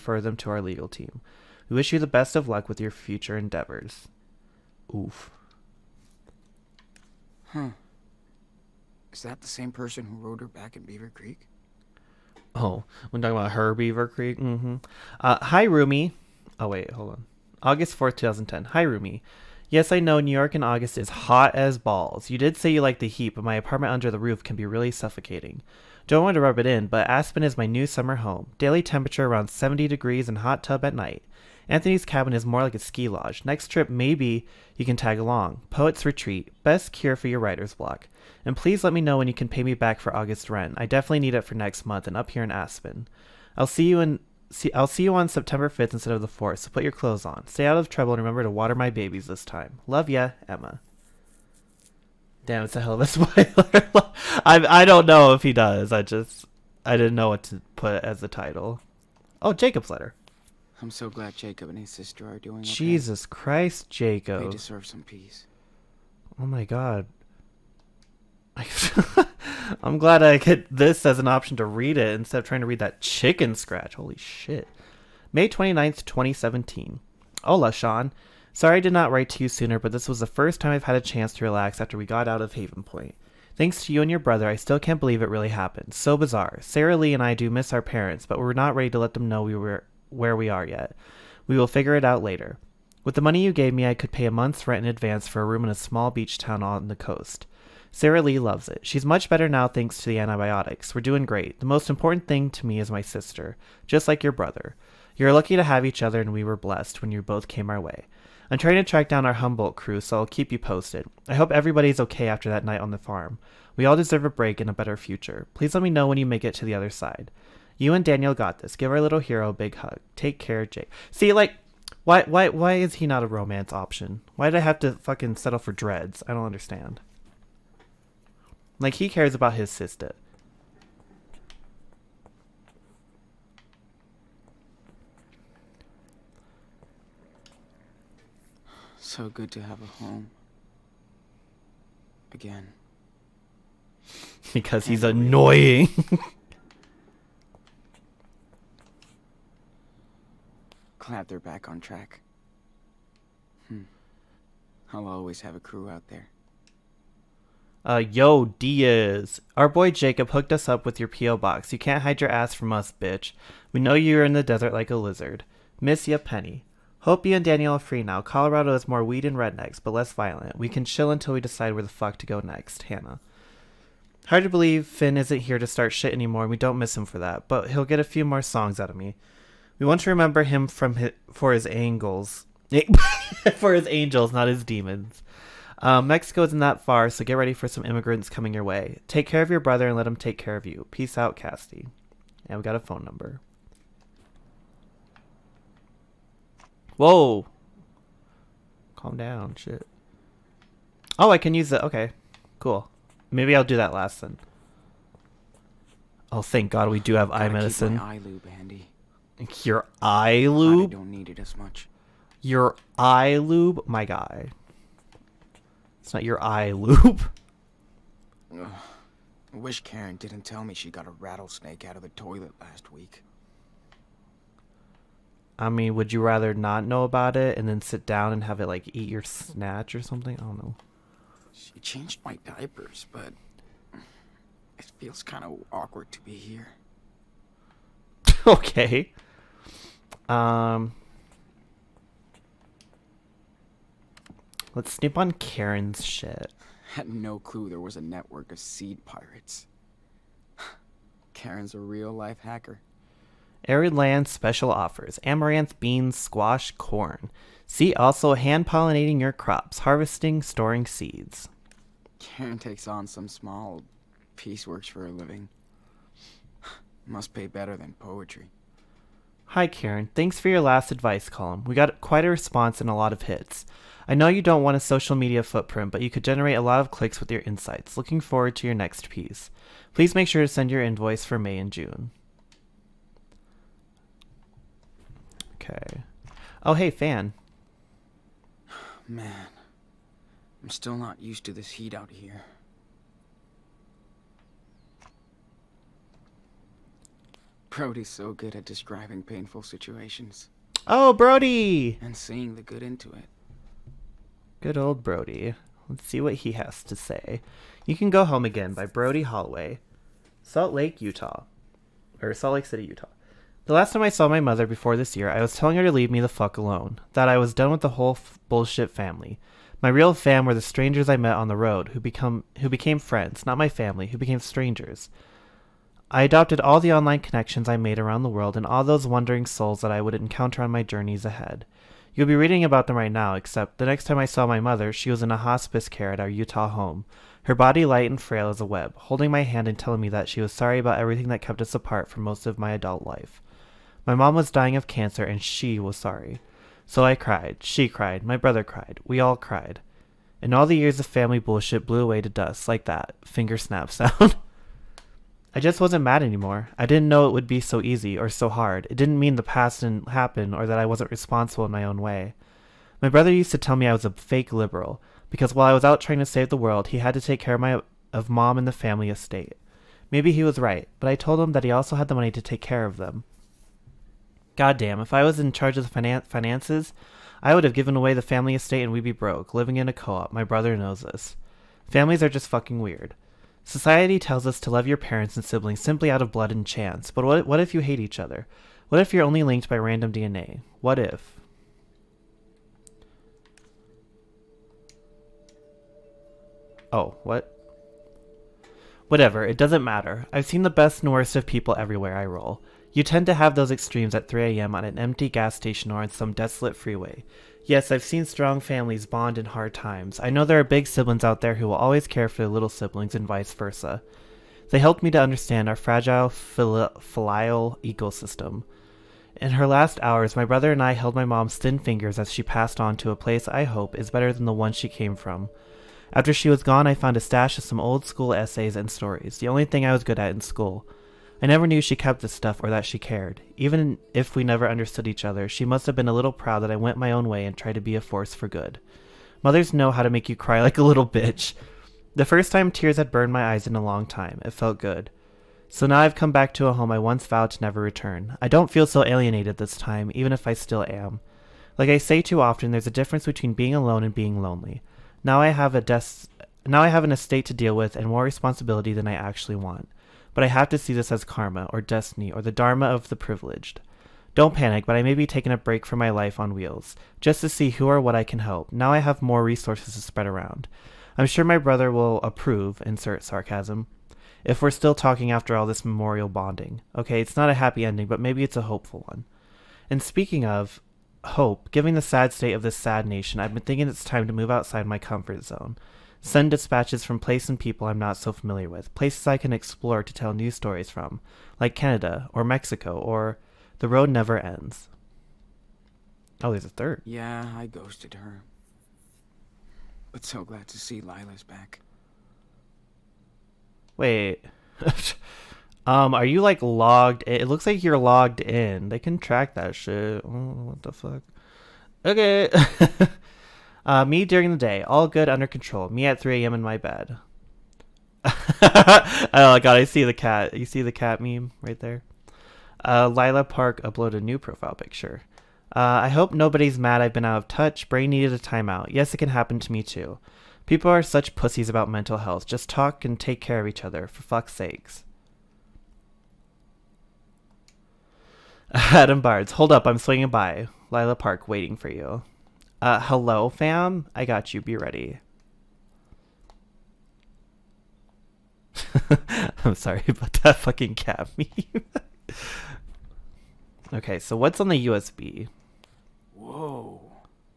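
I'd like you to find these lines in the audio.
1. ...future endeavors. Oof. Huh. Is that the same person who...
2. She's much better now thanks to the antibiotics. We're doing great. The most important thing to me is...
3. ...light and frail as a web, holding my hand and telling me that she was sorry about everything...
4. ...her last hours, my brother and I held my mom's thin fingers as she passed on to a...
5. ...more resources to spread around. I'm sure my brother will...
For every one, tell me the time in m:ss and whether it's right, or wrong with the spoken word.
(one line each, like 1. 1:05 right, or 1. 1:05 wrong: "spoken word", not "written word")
1. 0:02 right
2. 1:38 right
3. 5:37 right
4. 6:59 right
5. 7:49 right.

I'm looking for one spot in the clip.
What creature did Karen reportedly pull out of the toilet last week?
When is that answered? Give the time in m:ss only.
3:41.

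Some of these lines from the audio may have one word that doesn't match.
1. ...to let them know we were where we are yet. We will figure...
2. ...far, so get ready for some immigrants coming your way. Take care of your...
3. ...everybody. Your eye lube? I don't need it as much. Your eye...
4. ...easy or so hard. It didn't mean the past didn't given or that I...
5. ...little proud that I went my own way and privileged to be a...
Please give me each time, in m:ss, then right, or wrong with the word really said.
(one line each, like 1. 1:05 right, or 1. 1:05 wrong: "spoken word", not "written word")
1. 1:28 right
2. 3:06 right
3. 3:28 wrong: "handy", not "everybody"
4. 5:57 wrong: "happen", not "given"
5. 7:16 wrong: "tried", not "privileged".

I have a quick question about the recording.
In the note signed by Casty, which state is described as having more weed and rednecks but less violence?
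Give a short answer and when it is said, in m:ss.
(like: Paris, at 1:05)
Colorado, at 2:48.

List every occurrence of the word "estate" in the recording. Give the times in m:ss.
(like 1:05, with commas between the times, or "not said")
6:09, 6:18, 7:37.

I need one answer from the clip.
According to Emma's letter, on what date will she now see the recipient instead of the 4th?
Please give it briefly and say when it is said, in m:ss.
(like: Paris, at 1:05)
September 5th, at 0:45.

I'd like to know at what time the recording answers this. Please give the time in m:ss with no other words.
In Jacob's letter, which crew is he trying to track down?
1:49.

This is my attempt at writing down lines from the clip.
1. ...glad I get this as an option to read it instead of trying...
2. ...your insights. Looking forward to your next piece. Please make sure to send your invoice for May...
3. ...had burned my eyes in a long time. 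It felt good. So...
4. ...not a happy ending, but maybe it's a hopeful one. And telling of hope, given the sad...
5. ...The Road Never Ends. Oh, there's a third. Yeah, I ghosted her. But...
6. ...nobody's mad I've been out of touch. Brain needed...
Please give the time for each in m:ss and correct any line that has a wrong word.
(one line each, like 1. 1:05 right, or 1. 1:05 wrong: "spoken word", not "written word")
1. 1:09 right
2. 4:37 right
3. 7:22 right
4. 7:57 wrong: "speaking", not "telling"
5. 8:13 right
6. 8:46 right.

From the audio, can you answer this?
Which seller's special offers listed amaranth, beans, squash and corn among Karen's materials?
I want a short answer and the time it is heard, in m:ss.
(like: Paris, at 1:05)
Arid Land, at 4:13.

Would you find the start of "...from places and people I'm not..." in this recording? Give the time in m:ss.
8:07.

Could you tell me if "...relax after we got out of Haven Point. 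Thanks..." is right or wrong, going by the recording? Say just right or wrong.
right.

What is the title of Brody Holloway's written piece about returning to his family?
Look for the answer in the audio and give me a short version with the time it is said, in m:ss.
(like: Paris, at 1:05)
You Can Go Home Again, at 5:07.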